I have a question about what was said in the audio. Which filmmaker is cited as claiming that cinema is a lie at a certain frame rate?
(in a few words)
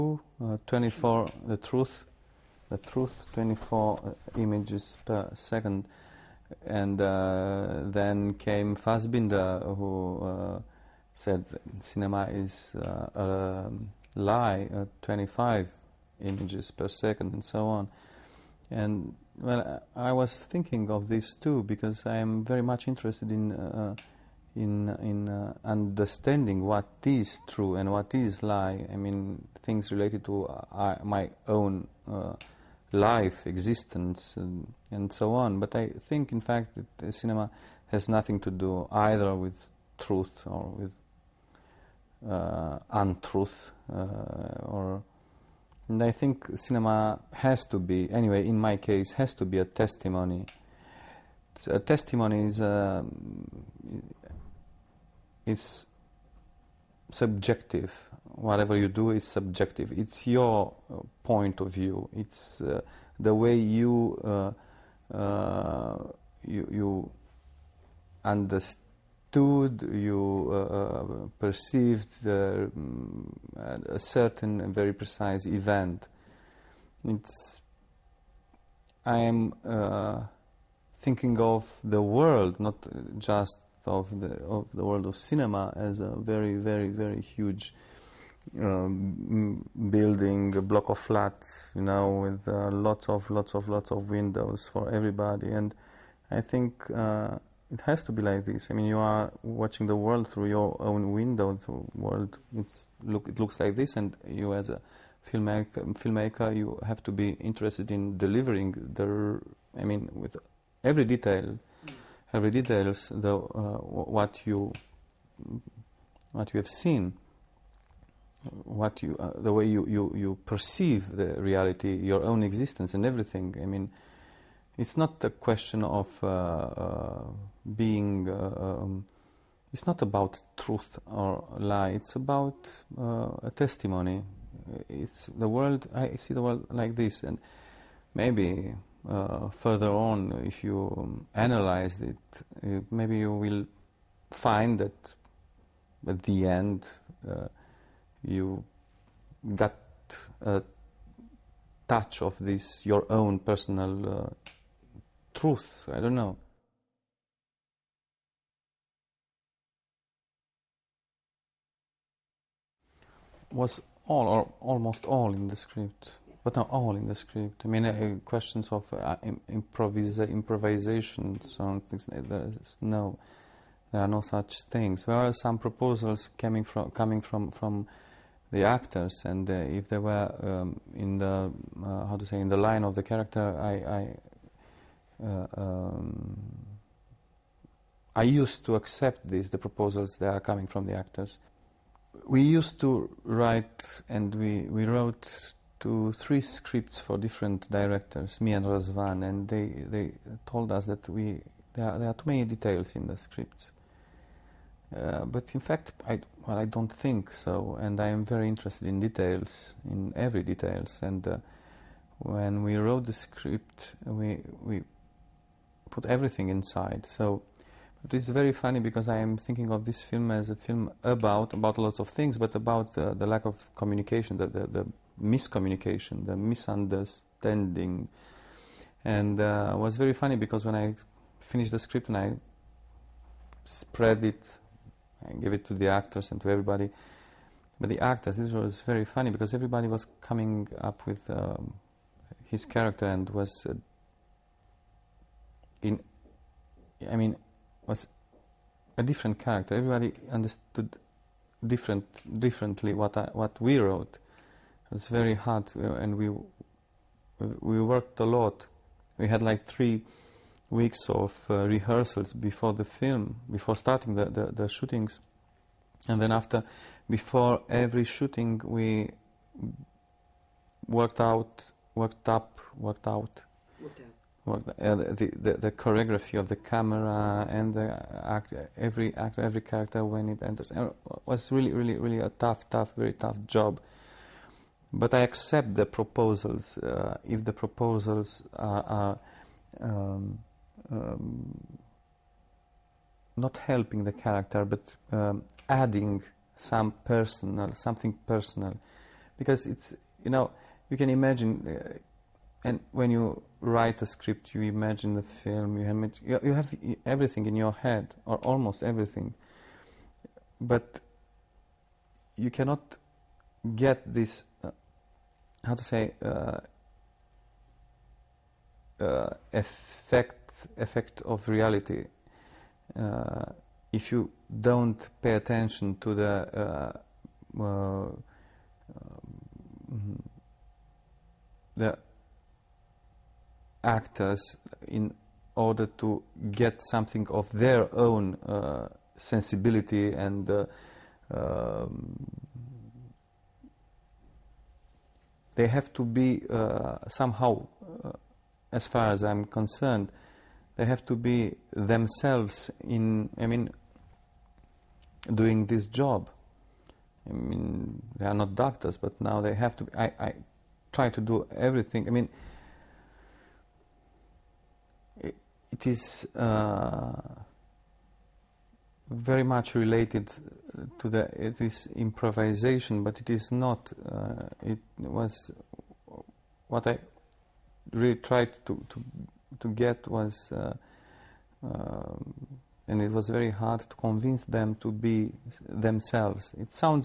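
Fassbinder.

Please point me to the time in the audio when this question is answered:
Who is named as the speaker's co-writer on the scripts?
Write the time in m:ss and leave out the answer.
3:18.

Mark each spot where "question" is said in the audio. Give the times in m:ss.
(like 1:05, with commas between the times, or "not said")
2:05, 2:48.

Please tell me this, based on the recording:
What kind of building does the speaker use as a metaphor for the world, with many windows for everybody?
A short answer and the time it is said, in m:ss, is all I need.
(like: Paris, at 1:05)
a block of flats, at 1:30.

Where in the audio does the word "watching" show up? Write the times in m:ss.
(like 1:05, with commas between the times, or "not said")
1:39.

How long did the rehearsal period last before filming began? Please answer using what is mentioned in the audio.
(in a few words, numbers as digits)
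3 weeks.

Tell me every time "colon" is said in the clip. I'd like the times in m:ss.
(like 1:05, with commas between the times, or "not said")
not said.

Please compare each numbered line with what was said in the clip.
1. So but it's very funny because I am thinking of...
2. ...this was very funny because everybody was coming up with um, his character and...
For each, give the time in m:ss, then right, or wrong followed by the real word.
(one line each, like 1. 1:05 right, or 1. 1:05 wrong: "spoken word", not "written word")
1. 3:37 right
2. 3:58 right.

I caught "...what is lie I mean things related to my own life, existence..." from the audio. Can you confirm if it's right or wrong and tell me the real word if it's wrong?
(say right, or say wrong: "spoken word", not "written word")
right.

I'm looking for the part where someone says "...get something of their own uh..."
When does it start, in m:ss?
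5:36.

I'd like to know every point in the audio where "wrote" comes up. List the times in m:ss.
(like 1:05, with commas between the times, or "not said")
3:14, 3:32, 4:13.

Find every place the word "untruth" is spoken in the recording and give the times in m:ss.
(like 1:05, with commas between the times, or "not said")
0:42.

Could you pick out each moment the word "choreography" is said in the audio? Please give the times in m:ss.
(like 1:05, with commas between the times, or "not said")
4:35.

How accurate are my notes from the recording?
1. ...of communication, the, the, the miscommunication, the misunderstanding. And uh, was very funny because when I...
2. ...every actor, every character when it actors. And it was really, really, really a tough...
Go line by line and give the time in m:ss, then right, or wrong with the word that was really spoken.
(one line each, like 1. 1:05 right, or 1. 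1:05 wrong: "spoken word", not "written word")
1. 3:43 right
2. 4:38 wrong: "enters", not "actors".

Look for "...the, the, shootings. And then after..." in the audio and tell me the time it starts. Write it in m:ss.
4:24.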